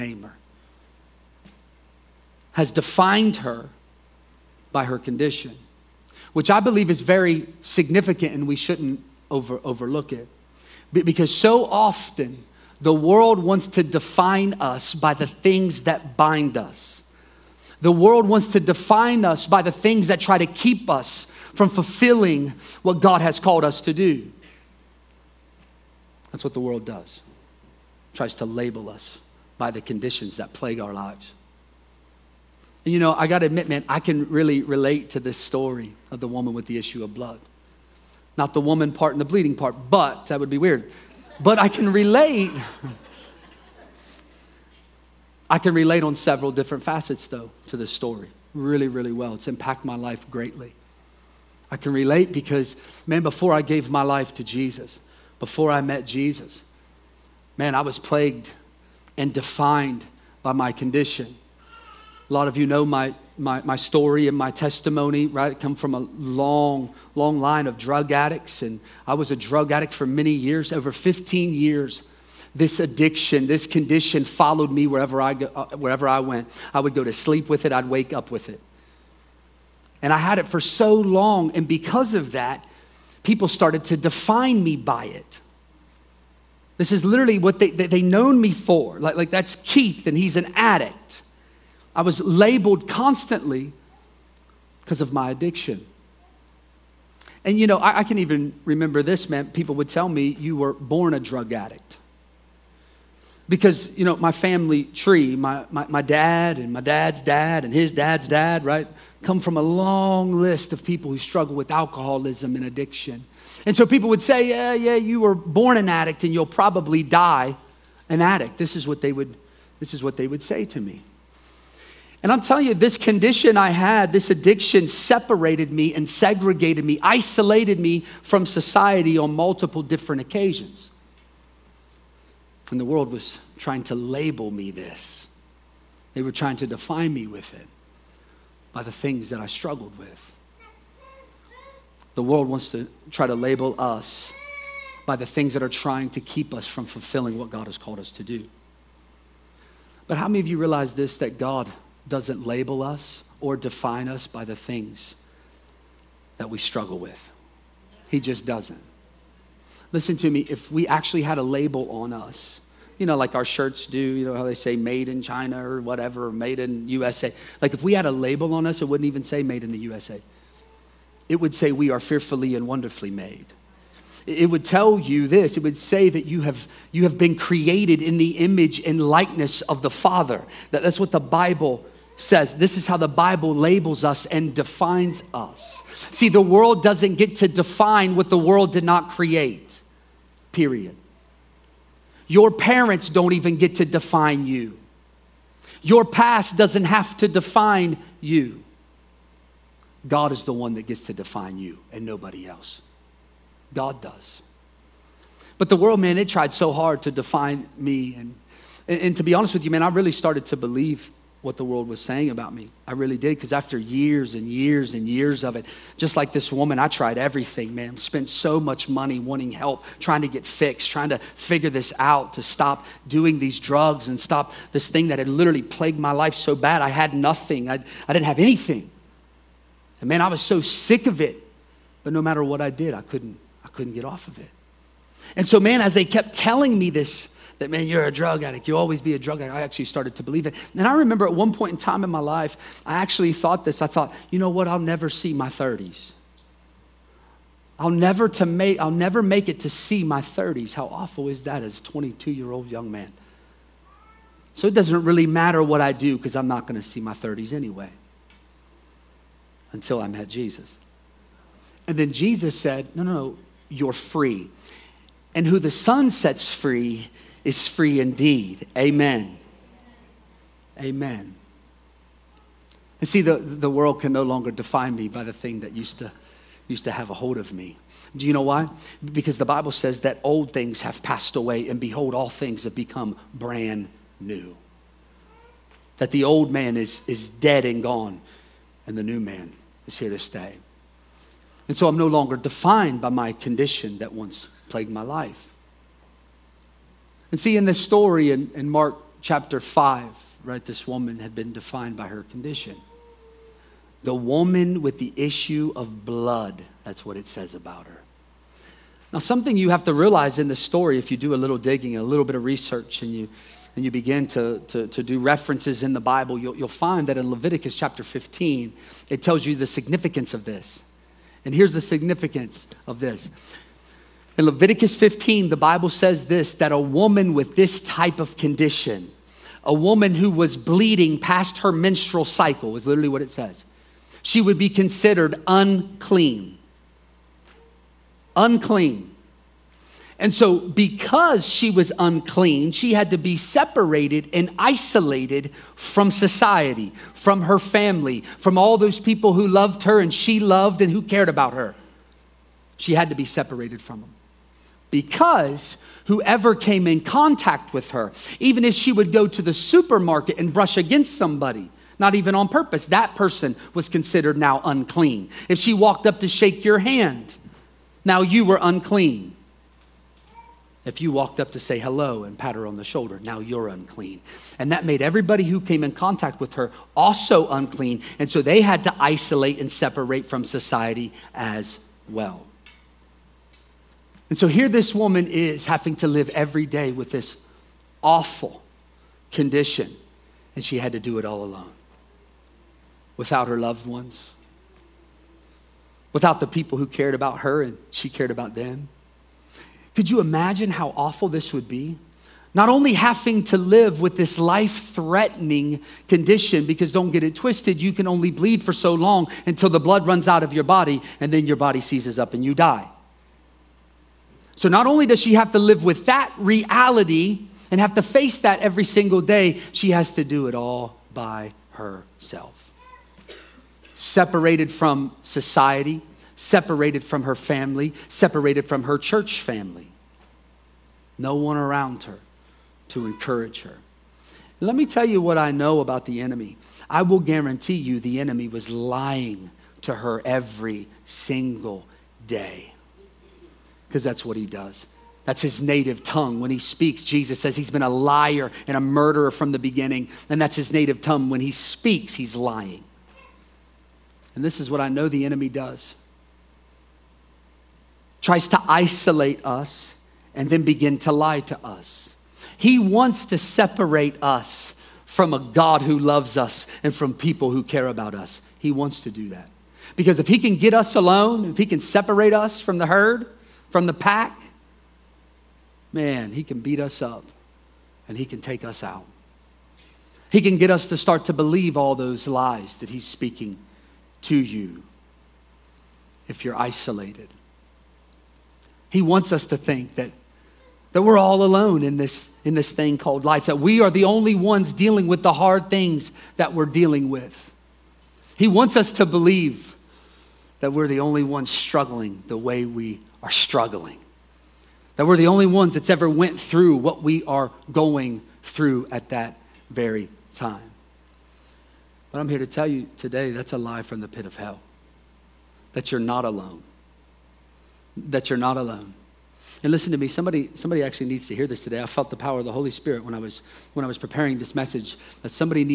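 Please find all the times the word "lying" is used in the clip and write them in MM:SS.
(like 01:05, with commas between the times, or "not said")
07:18, 07:32.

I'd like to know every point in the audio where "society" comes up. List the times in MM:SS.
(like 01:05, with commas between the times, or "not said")
02:08, 05:46, 06:20, 07:05.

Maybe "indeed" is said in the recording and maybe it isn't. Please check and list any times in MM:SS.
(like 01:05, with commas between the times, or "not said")
04:27.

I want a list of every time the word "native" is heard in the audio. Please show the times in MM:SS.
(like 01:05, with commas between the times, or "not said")
07:25, 07:30.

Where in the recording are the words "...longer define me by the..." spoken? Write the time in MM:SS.
04:34.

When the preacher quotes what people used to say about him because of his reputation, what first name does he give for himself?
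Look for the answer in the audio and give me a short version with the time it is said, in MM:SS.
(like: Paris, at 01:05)
Keith, at 01:29.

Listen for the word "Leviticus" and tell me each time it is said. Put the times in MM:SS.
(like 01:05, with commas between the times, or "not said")
05:17, 05:24.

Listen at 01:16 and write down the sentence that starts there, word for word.
I would go to sleep with it, I'd wake up with it.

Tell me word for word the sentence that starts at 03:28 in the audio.
And, and, and to be honest with you, man, I really started to believe what the world was saying about me.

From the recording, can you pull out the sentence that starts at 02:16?
They were trying to define me with it by the things that I struggled with.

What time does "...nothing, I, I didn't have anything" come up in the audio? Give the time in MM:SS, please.
03:47.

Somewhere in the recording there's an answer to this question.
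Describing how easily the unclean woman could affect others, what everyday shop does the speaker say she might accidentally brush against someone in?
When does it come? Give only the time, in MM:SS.
05:59.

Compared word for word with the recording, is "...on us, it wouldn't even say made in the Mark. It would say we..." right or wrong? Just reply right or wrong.
wrong.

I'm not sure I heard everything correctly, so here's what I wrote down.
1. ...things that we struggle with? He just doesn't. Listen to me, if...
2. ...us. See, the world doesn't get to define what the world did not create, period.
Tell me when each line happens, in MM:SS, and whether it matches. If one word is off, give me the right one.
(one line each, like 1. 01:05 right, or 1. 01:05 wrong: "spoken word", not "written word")
1. 02:34 right
2. 03:05 right.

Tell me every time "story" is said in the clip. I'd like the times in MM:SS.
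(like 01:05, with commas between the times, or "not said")
00:35, 00:47, 01:03, 04:57, 05:10.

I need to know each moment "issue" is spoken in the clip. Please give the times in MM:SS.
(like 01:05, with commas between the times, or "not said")
00:36, 05:05.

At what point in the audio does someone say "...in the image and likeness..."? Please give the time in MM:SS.
02:58.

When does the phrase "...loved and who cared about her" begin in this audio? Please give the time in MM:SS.
05:50.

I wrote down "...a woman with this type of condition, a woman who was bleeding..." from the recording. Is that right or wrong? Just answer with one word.
right.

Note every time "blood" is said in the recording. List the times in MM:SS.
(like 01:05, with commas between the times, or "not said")
00:37, 05:06, 06:49.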